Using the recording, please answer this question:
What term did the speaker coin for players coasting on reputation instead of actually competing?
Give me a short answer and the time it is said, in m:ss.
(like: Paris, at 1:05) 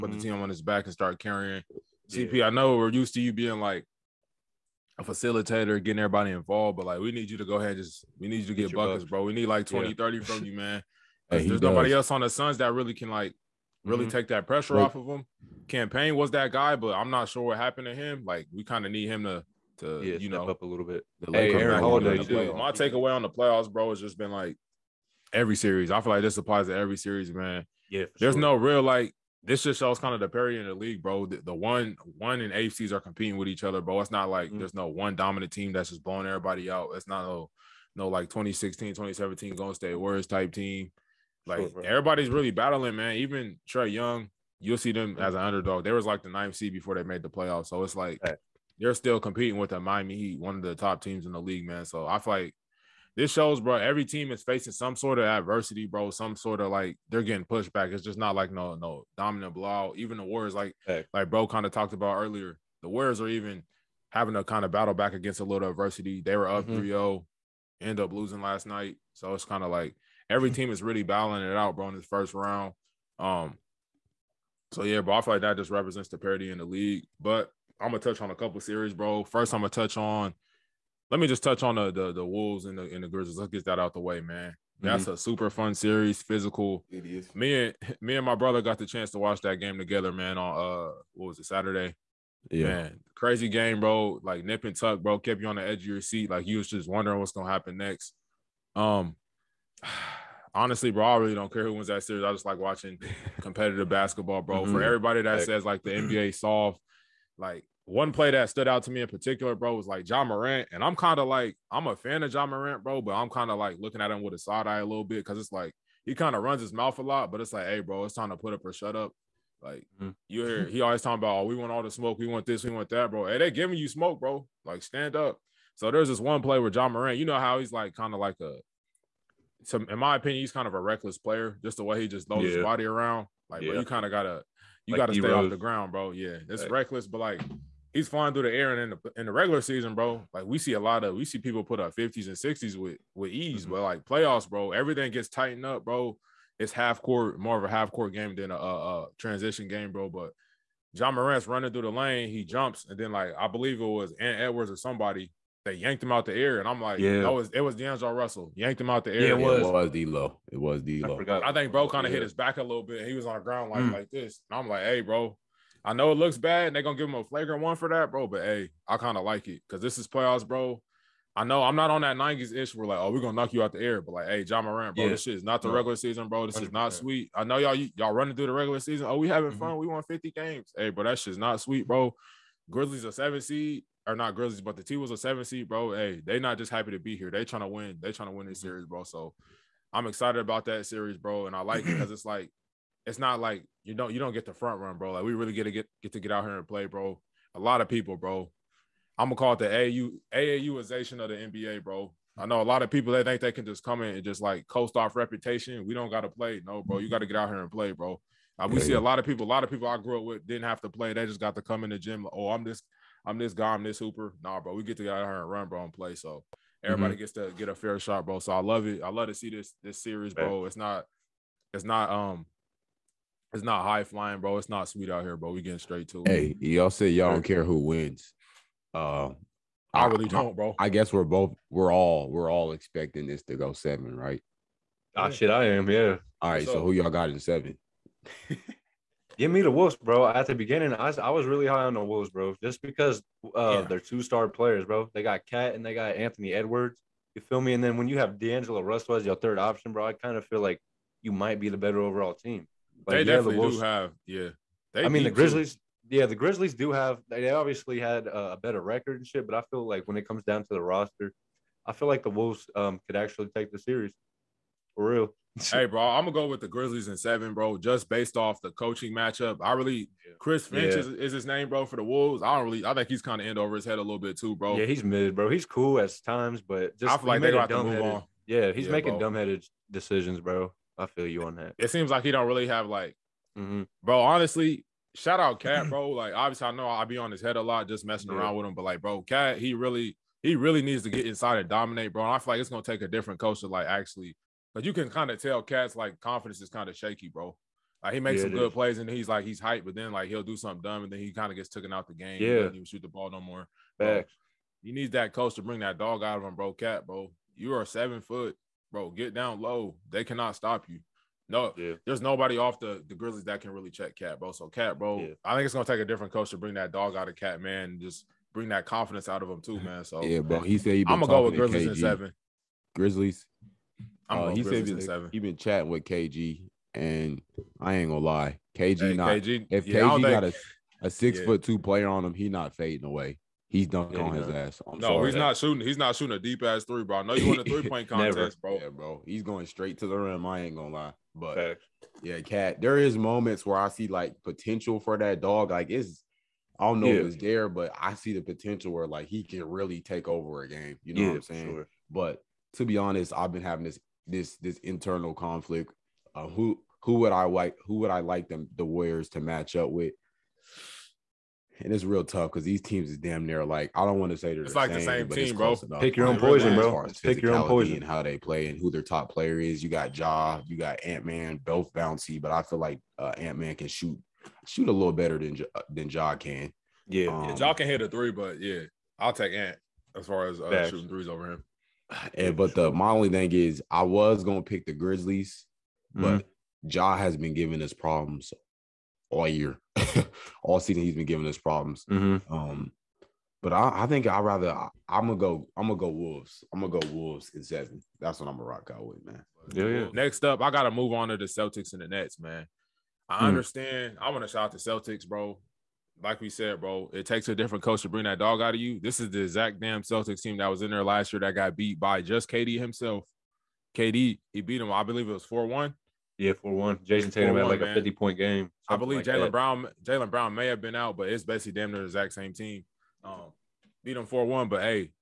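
AAUization of the NBA, at 3:20.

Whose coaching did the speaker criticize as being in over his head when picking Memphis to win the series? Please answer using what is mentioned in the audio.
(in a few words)
Chris Finch.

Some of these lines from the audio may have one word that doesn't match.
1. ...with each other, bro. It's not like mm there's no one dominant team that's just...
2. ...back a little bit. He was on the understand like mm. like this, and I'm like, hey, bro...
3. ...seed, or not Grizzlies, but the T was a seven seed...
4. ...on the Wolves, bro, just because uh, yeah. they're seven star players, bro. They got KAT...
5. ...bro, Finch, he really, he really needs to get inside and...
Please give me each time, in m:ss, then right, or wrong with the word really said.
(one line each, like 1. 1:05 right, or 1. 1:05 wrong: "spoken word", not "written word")
1. 0:33 right
2. 2:42 wrong: "ground", not "understand"
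3. 3:03 right
4. 4:01 wrong: "two", not "seven"
5. 4:49 wrong: "Cat", not "Finch".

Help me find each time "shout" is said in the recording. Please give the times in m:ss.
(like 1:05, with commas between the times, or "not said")
4:45, 6:44.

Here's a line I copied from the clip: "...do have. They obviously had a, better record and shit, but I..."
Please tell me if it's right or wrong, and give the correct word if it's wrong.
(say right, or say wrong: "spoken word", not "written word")
right.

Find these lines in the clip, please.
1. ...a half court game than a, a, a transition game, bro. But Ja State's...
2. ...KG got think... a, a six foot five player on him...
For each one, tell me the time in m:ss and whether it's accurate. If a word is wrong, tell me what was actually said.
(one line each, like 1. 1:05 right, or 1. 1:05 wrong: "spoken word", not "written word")
1. 2:27 wrong: "Morant", not "State"
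2. 5:30 wrong: "two", not "five".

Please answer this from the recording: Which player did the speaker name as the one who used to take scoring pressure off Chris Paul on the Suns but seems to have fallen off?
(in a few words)
Cam Payne.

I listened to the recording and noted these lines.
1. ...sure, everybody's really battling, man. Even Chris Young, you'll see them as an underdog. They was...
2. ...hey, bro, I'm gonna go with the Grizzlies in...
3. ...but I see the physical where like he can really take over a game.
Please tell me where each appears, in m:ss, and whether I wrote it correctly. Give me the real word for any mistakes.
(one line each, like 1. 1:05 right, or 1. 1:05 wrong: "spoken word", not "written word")
1. 0:41 wrong: "Trae", not "Chris"
2. 4:25 right
3. 5:47 wrong: "potential", not "physical".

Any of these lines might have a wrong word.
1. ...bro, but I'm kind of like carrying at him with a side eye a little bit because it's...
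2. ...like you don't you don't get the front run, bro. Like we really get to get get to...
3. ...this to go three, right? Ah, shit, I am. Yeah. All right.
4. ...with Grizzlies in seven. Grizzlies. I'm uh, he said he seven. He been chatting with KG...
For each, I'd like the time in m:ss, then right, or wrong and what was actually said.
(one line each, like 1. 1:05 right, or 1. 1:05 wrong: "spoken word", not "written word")
1. 1:52 wrong: "looking", not "carrying"
2. 3:13 right
3. 3:53 wrong: "seven", not "three"
4. 5:21 right.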